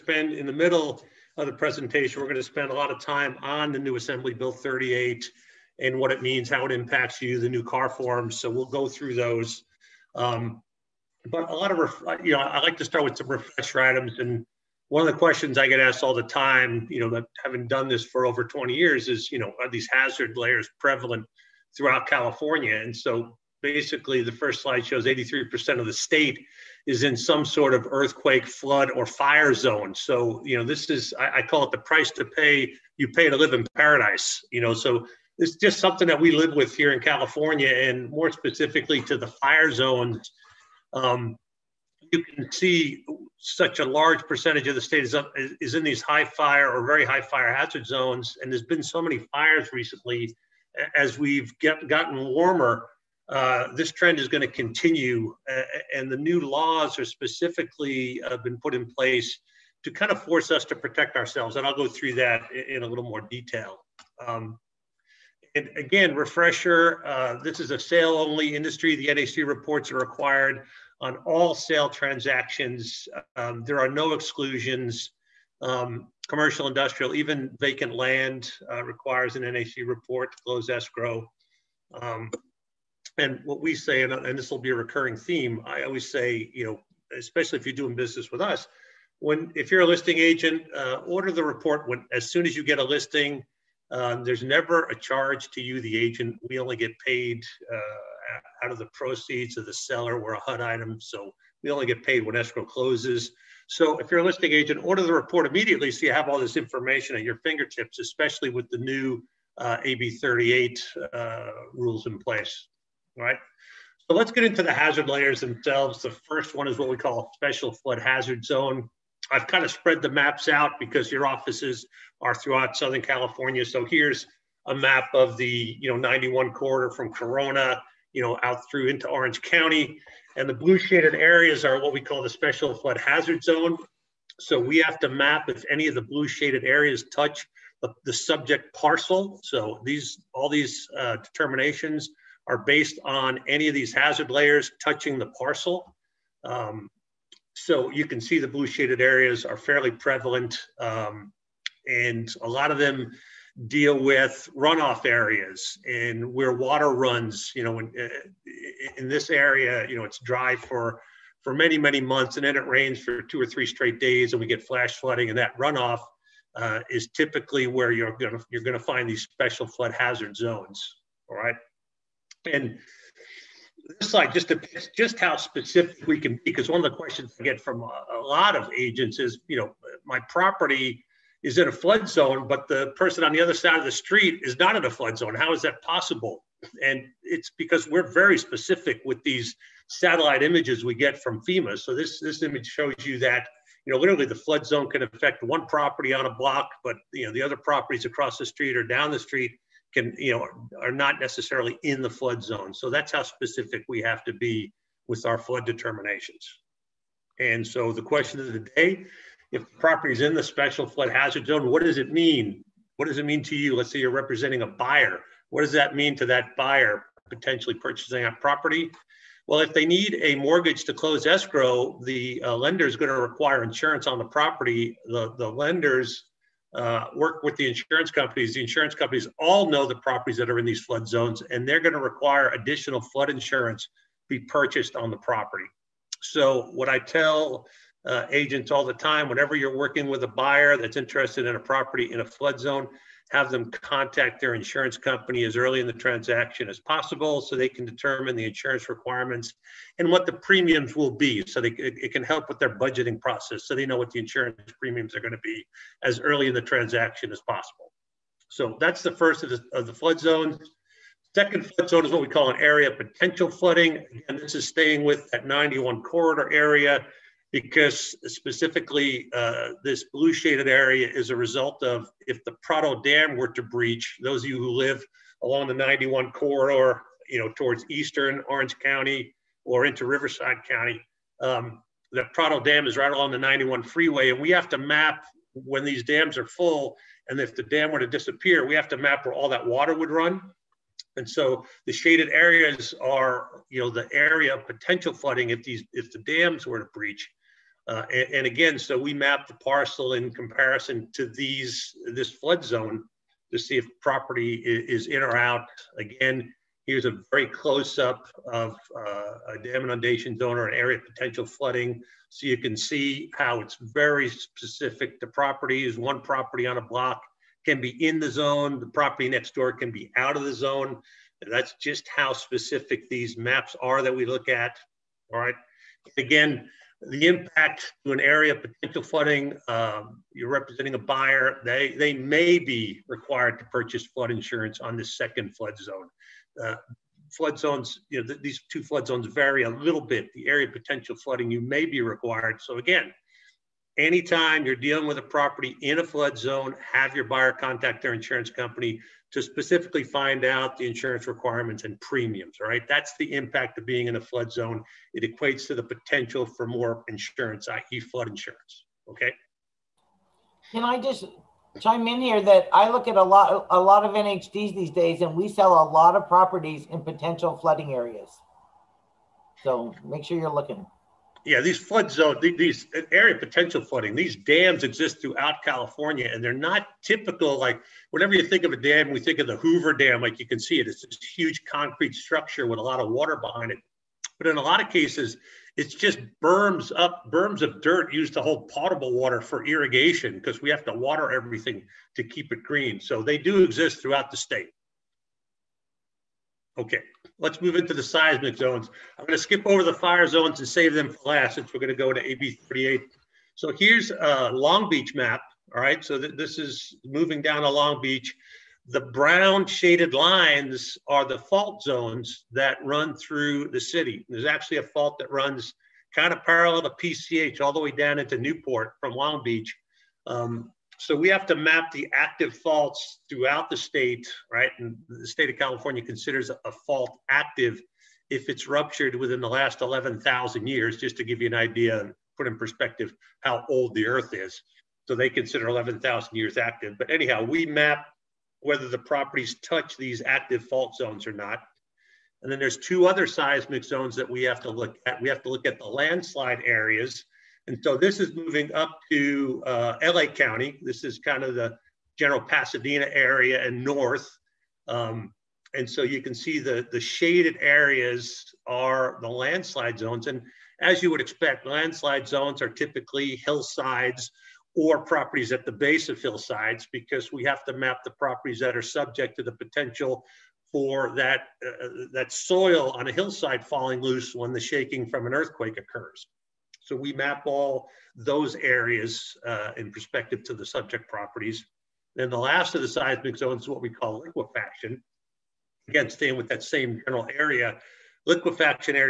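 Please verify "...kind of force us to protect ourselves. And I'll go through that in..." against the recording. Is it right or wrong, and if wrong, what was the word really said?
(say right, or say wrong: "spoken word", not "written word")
right.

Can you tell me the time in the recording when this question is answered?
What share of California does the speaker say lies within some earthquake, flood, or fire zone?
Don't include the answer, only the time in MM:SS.
00:25.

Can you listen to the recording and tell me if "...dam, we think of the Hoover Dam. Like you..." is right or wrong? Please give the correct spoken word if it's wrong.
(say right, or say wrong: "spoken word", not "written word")
right.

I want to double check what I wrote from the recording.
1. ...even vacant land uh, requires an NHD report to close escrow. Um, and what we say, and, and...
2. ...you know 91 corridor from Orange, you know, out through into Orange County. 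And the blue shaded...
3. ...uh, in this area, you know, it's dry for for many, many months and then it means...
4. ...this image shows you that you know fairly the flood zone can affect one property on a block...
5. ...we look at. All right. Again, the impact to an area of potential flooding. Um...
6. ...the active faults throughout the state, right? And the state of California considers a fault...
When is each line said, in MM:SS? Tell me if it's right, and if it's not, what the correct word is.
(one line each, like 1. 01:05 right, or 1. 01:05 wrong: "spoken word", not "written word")
1. 01:17 right
2. 02:05 wrong: "Corona", not "Orange"
3. 02:37 wrong: "rains", not "means"
4. 03:12 wrong: "literally", not "fairly"
5. 05:24 right
6. 07:01 right.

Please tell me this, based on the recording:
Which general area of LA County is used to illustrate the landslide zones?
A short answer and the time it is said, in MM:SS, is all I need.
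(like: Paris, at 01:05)
Pasadena, at 07:32.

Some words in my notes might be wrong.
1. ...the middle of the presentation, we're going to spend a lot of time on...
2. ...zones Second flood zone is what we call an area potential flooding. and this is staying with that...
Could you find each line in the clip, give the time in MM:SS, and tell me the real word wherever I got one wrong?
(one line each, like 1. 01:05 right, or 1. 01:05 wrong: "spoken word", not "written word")
1. 00:00 right
2. 04:20 right.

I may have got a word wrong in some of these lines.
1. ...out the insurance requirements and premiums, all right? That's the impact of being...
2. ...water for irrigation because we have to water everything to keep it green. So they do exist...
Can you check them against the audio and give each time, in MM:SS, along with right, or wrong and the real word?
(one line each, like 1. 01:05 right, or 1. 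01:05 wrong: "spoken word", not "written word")
1. 05:50 right
2. 06:29 right.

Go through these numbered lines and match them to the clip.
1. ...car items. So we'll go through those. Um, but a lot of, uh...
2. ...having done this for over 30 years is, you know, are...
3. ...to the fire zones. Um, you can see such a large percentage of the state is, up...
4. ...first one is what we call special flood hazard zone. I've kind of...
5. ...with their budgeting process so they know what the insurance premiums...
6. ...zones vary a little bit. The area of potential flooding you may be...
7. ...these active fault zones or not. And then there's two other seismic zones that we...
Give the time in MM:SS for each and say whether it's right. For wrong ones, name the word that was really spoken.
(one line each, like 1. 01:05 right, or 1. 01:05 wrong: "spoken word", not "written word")
1. 00:07 wrong: "forms", not "items"
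2. 00:17 wrong: "20", not "30"
3. 00:39 right
4. 01:56 right
5. 04:12 right
6. 05:39 right
7. 07:19 right.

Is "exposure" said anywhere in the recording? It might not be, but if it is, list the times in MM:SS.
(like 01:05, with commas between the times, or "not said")
not said.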